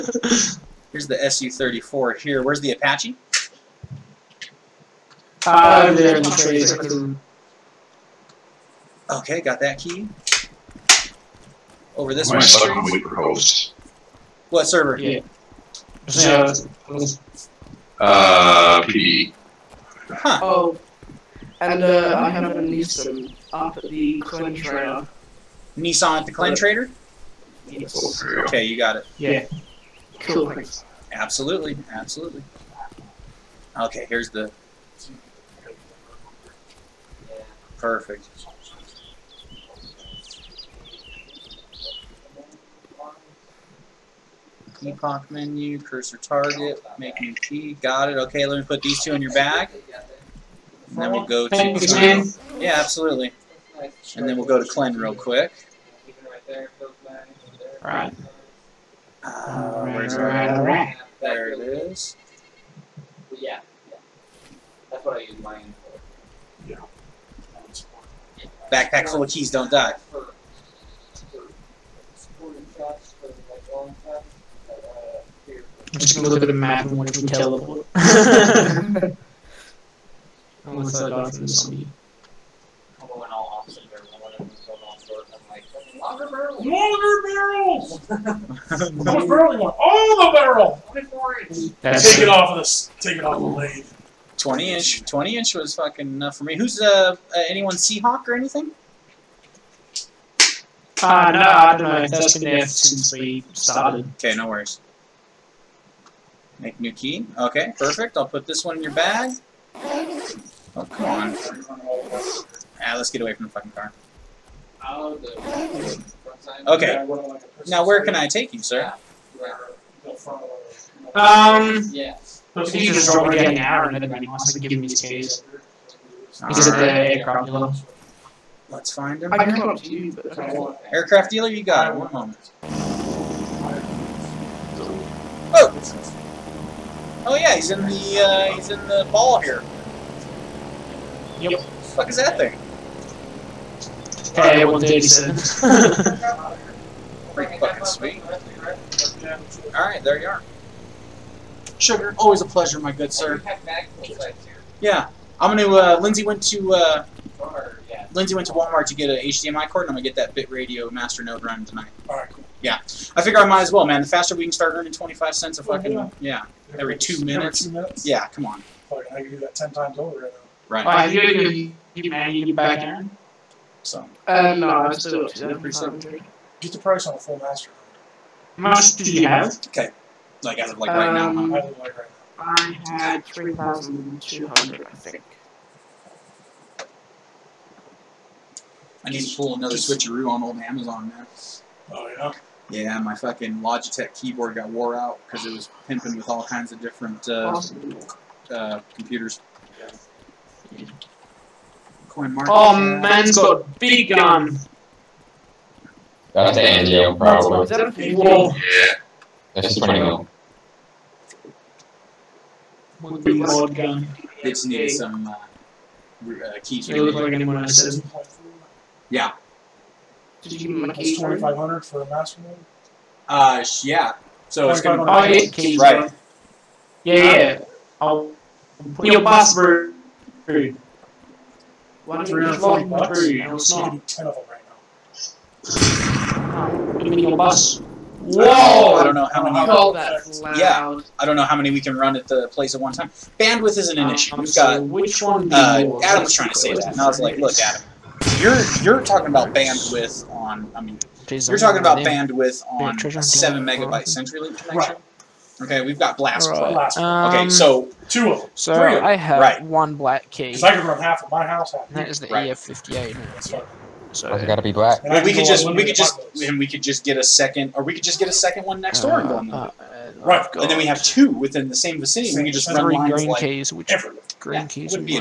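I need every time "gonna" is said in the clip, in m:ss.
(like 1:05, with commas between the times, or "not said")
1:16, 2:35, 2:39, 3:44.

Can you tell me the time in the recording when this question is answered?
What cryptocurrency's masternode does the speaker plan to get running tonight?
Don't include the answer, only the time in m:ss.
2:40.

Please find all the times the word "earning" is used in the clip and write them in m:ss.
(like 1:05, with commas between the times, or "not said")
2:44.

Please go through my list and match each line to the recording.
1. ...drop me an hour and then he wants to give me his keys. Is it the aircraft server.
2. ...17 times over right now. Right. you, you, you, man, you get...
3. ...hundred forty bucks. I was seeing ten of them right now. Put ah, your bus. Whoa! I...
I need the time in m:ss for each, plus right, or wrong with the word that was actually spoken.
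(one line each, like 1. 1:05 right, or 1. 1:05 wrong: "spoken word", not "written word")
1. 2:03 wrong: "dealer", not "server"
2. 2:49 wrong: "10", not "17"
3. 3:52 right.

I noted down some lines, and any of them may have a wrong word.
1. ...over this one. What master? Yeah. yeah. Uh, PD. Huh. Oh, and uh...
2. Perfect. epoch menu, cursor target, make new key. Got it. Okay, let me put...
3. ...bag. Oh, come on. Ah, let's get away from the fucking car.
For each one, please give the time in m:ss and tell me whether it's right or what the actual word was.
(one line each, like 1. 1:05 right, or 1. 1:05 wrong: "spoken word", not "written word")
1. 0:11 wrong: "server", not "master"
2. 0:37 right
3. 1:48 right.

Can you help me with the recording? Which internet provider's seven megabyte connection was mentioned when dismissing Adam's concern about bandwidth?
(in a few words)
CenturyLink.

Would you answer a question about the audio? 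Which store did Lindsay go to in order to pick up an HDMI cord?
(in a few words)
Walmart.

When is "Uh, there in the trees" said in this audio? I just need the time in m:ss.
0:05.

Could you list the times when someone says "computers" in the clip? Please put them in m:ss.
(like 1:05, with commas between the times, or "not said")
3:18.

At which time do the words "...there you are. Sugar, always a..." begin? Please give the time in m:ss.
2:30.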